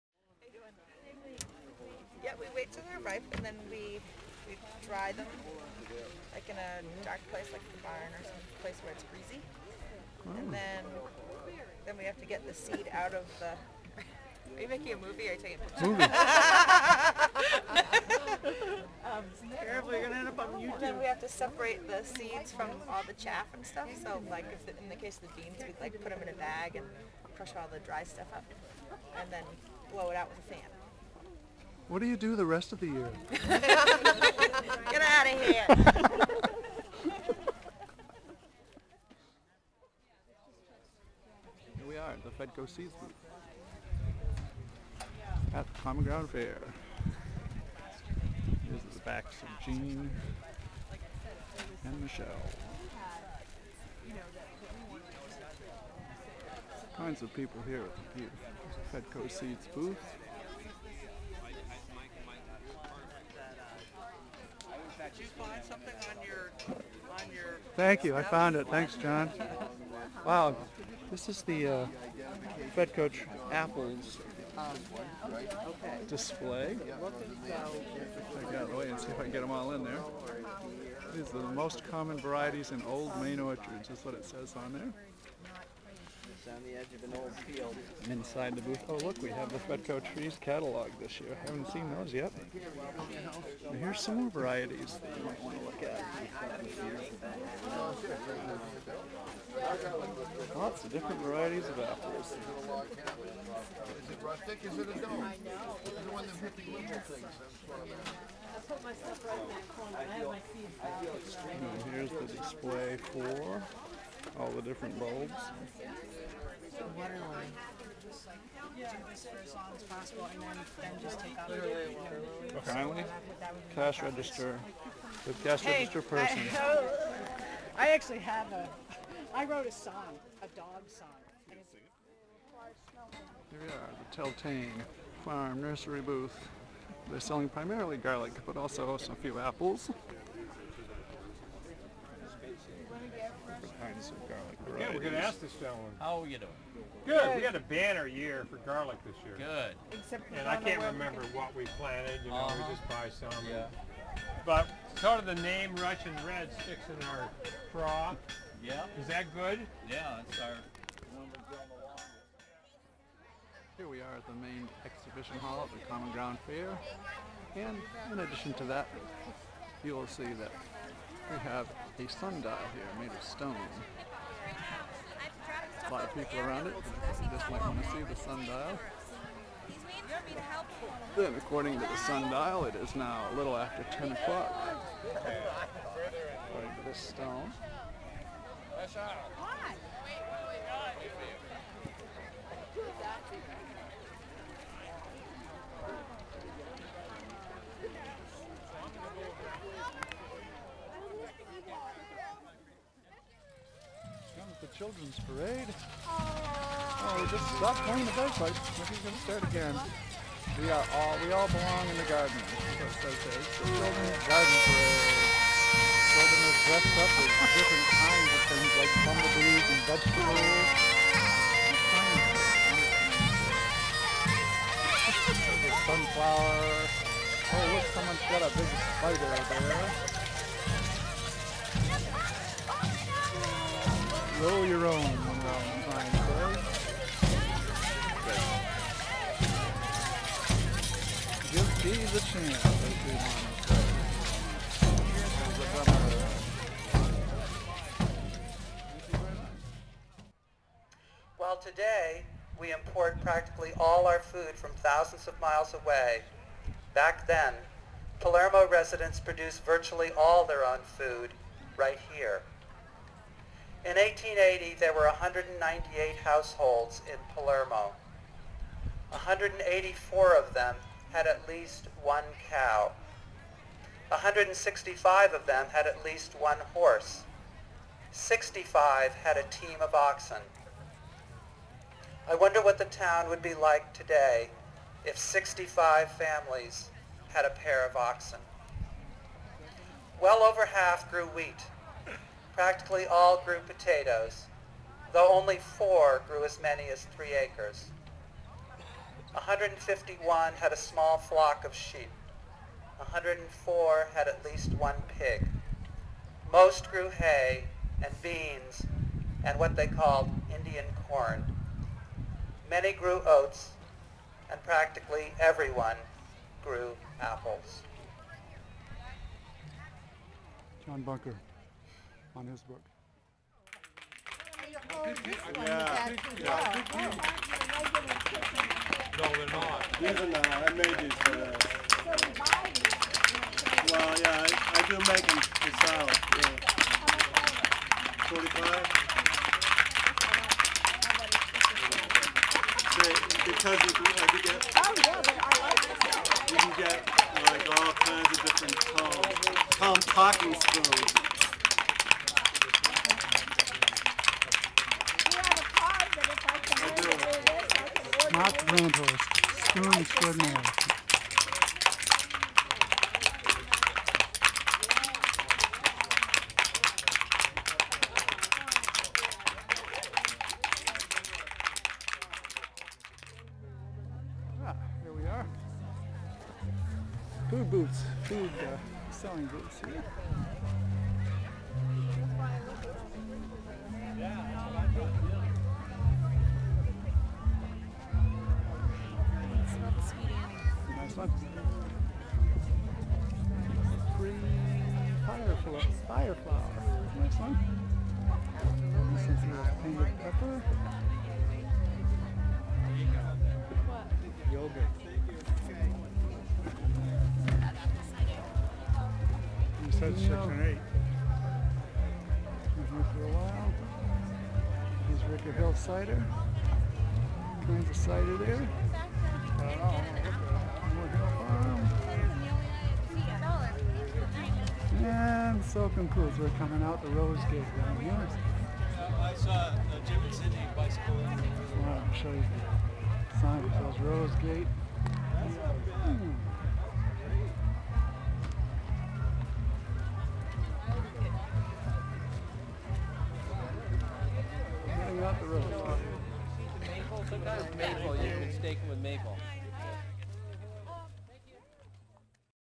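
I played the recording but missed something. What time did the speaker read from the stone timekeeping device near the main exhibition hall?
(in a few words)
a little after 10.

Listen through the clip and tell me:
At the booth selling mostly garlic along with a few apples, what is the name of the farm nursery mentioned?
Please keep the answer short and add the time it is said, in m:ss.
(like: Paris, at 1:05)
Teltane, at 2:14.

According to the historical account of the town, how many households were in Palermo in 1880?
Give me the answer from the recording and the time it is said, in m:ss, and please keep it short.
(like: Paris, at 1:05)
198, at 4:25.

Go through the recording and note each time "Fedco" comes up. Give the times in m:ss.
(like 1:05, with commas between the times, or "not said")
0:42, 0:59, 1:12, 1:29.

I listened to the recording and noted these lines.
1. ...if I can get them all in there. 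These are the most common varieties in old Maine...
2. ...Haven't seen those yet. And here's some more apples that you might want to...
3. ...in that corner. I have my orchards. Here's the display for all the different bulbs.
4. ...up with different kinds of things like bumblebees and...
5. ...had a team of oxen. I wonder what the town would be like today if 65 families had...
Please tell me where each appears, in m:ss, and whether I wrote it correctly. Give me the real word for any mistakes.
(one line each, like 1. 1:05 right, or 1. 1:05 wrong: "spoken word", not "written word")
1. 1:19 right
2. 1:31 wrong: "varieties", not "apples"
3. 1:49 wrong: "seeds", not "orchards"
4. 3:37 right
5. 4:39 right.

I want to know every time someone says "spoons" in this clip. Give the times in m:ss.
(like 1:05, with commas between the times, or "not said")
5:50, 5:59.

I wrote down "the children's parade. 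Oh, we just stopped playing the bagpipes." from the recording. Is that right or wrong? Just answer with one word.
right.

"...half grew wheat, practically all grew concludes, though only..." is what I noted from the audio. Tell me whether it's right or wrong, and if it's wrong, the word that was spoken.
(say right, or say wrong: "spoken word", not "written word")
wrong: "potatoes", not "concludes".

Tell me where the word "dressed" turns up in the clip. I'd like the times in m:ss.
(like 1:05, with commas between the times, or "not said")
3:36.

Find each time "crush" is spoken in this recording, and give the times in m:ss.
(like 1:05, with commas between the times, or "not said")
0:27.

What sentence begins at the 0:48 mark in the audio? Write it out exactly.
Here's the backs of Jean and Michelle.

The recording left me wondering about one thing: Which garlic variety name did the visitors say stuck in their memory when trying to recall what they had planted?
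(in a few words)
Russian Red.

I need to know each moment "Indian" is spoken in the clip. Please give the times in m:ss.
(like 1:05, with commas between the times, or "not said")
5:10.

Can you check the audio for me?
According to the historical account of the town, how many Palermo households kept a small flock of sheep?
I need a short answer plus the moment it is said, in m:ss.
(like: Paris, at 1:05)
151, at 4:59.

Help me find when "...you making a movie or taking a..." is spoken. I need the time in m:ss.
0:14.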